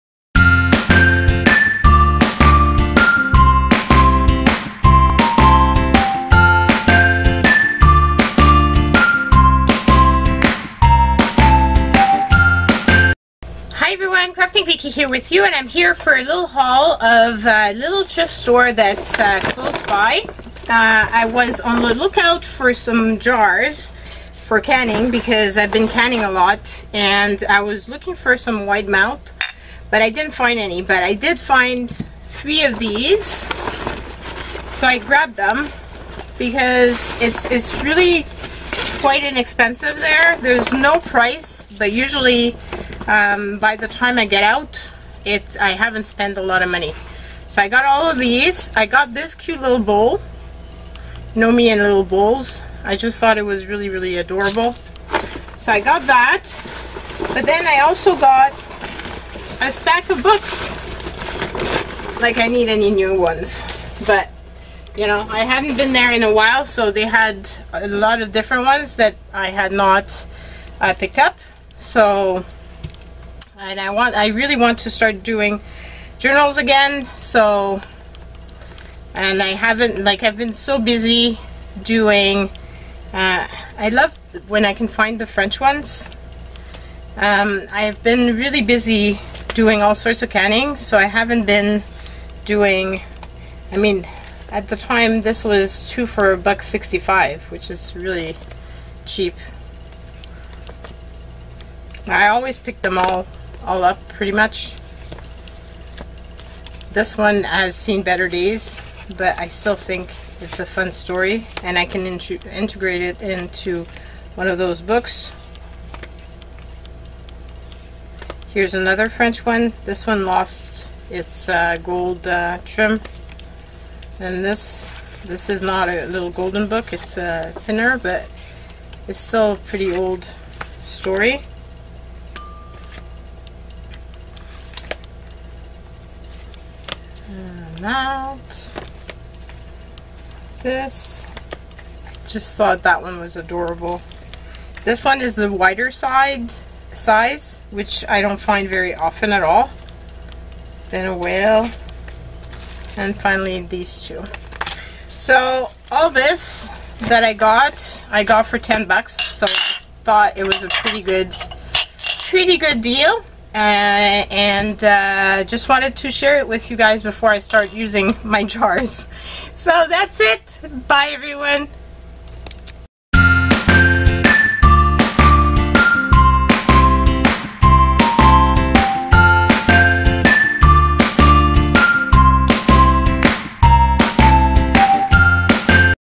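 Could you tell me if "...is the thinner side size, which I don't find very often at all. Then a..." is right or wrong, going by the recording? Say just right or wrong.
wrong.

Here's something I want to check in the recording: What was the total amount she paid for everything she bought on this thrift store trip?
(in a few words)
$10.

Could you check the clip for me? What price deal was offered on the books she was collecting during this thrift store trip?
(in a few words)
2 for $1.65.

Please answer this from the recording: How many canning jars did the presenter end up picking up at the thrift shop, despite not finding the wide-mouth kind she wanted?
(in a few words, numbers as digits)
3.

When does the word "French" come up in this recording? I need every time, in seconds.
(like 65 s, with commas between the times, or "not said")
85 s, 119 s.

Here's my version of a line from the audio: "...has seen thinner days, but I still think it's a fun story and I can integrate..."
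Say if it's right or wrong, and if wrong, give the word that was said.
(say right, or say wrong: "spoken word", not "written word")
wrong: "better", not "thinner".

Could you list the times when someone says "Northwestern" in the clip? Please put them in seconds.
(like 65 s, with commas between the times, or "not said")
not said.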